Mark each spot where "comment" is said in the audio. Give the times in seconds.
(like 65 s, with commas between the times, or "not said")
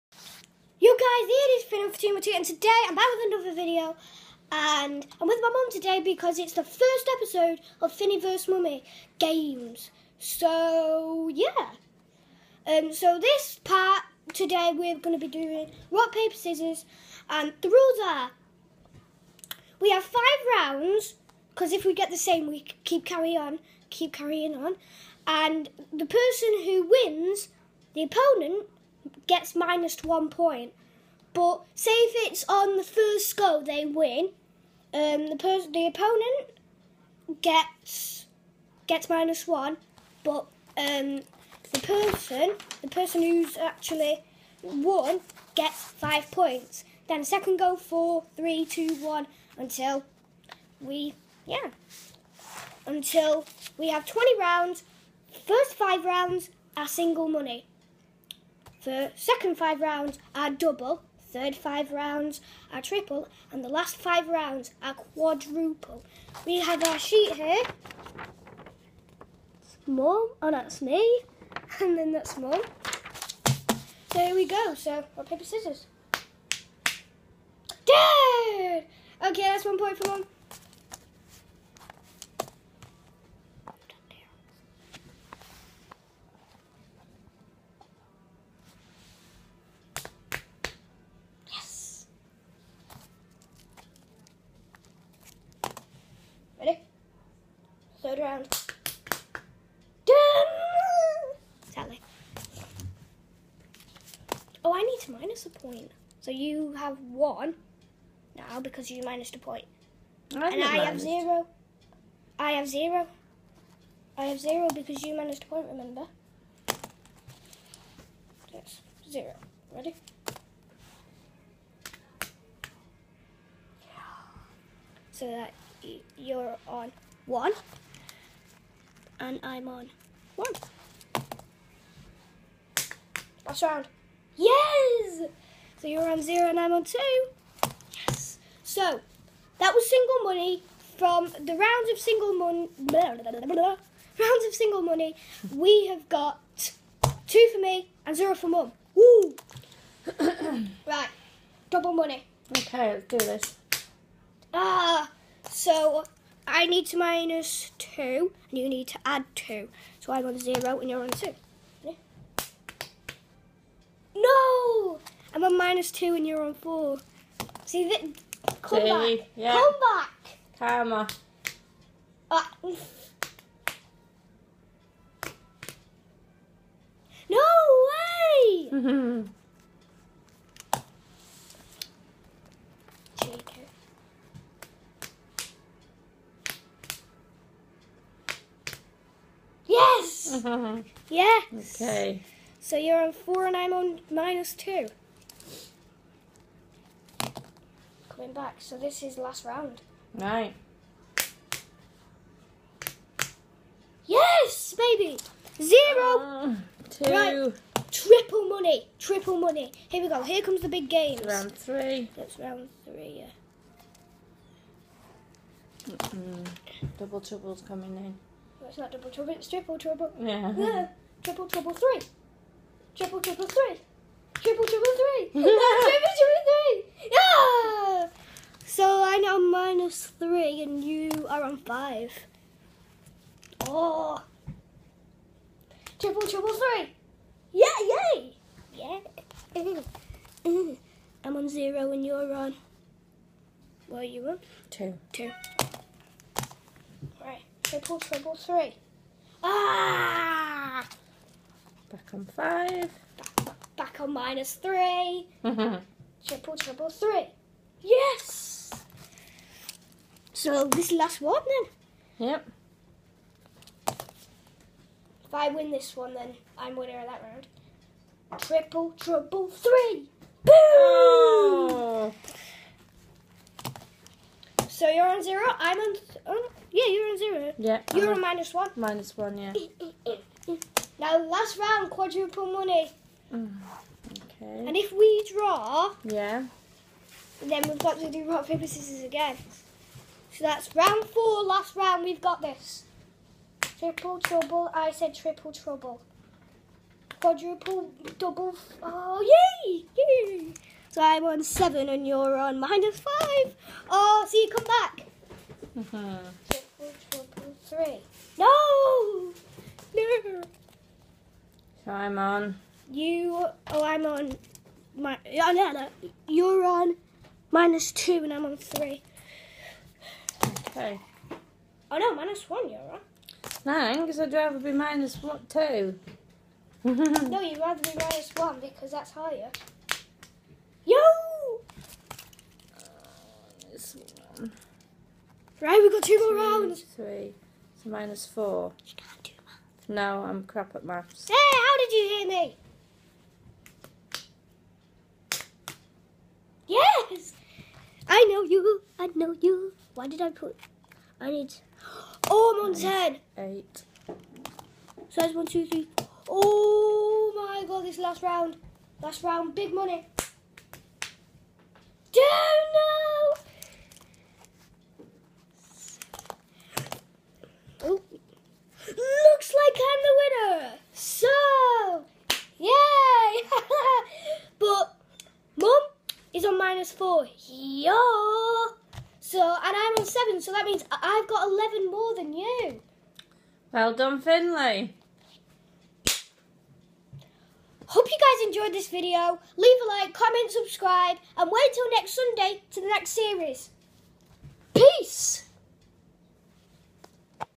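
390 s.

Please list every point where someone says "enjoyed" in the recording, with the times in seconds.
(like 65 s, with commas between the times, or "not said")
388 s.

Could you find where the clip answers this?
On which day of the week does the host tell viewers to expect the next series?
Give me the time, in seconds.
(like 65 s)
392 s.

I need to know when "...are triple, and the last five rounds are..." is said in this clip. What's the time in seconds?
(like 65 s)
62 s.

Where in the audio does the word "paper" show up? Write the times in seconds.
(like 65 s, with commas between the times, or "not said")
16 s, 75 s, 288 s.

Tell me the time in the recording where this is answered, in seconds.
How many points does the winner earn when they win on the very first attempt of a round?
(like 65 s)
45 s.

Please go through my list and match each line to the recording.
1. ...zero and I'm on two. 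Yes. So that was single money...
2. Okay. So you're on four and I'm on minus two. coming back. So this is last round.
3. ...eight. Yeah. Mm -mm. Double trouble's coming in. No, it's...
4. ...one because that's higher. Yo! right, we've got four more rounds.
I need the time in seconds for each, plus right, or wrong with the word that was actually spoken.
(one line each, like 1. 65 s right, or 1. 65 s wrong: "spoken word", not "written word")
1. 136 s right
2. 191 s right
3. 212 s wrong: "three", not "eight"
4. 328 s wrong: "two", not "four".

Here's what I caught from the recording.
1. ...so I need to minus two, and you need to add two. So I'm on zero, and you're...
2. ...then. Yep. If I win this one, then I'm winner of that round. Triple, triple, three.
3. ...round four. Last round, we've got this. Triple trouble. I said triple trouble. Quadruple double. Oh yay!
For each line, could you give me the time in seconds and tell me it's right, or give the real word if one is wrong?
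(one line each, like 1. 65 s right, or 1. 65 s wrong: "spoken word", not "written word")
1. 155 s right
2. 262 s right
3. 290 s right.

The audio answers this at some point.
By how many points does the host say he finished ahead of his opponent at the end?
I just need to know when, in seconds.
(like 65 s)
381 s.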